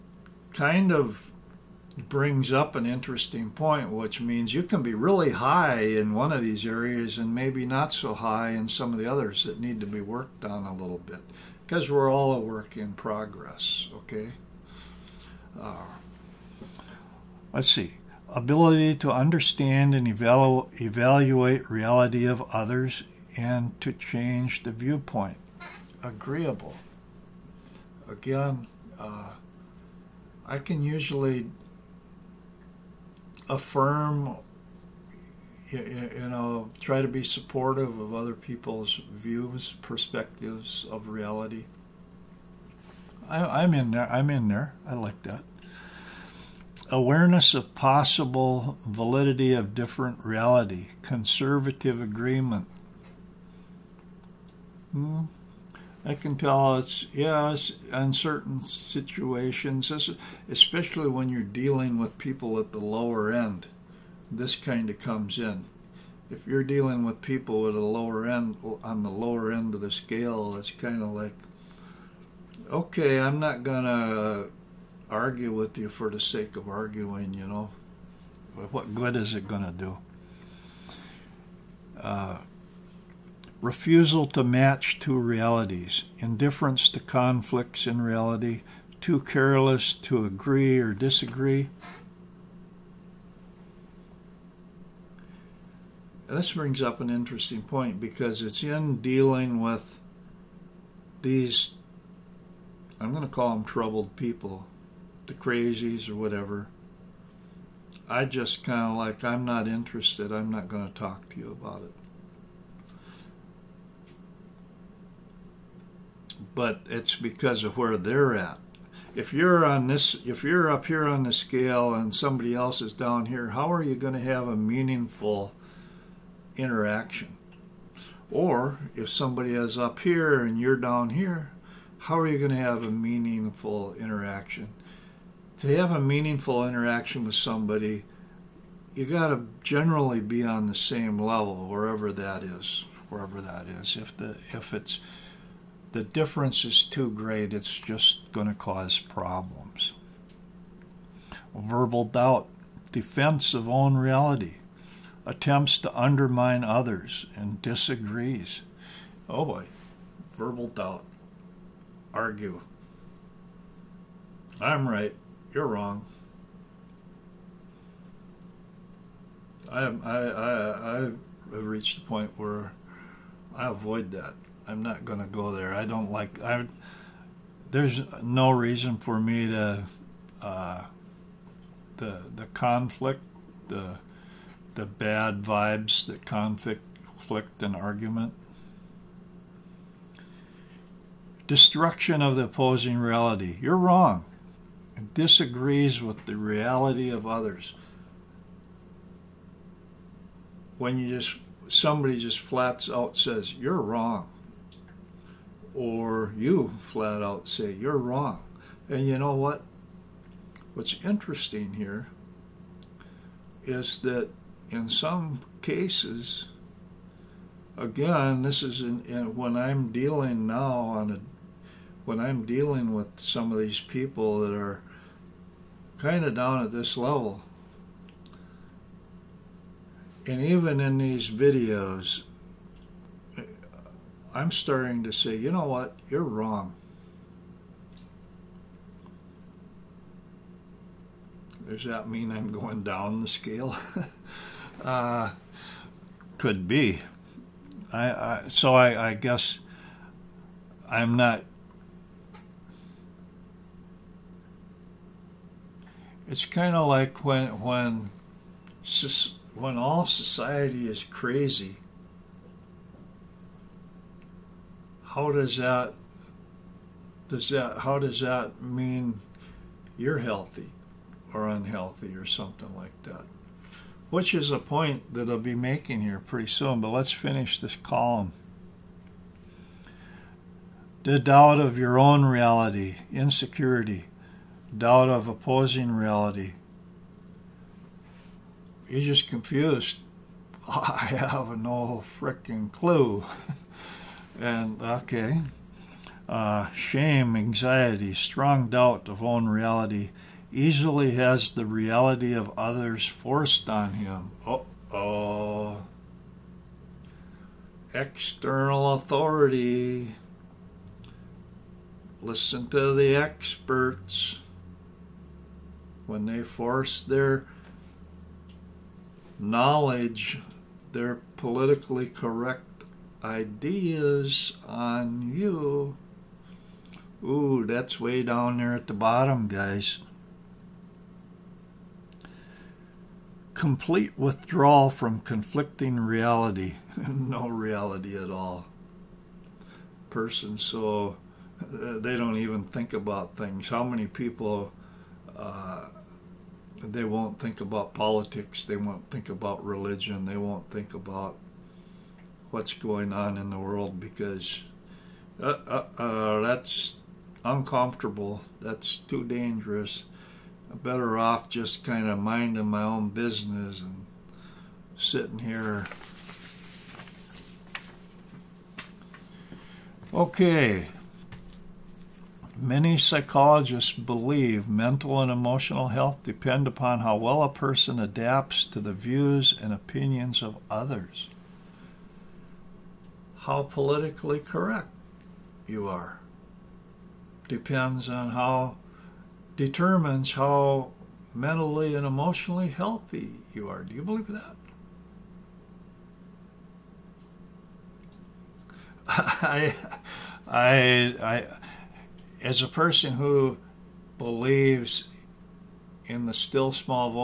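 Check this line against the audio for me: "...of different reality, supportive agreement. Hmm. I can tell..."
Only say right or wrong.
wrong.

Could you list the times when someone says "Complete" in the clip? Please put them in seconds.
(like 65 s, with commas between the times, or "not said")
333 s.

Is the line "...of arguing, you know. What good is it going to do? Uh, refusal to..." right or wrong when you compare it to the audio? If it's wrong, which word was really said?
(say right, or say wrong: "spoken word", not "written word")
right.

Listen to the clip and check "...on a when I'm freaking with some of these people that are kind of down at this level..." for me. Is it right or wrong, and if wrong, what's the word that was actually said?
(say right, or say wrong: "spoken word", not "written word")
wrong: "dealing", not "freaking".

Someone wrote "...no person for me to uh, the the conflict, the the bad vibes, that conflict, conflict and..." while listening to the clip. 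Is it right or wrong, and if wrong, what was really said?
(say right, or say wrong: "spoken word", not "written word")
wrong: "reason", not "person".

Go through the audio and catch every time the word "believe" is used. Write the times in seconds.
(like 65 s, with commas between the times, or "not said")
373 s, 394 s, 404 s.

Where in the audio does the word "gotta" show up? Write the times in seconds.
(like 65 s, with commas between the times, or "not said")
not said.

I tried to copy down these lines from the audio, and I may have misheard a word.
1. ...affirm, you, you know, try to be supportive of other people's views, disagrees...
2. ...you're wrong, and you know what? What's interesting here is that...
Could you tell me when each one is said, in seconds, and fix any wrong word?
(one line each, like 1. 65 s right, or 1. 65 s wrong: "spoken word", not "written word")
1. 33 s wrong: "perspectives", not "disagrees"
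2. 207 s right.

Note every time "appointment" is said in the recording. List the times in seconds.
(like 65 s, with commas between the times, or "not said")
not said.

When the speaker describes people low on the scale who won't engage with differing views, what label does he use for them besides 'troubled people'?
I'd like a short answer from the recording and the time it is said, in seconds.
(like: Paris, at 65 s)
the crazies, at 105 s.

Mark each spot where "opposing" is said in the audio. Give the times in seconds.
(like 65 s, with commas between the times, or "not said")
192 s, 285 s.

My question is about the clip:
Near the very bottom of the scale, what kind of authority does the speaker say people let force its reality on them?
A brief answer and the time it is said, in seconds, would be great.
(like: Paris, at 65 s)
External authority, at 307 s.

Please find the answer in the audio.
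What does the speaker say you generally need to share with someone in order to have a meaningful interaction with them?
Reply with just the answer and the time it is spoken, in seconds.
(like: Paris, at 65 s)
the same level, at 140 s.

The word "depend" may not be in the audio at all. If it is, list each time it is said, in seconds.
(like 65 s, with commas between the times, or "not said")
376 s, 387 s.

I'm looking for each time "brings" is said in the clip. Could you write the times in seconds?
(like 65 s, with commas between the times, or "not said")
2 s, 96 s.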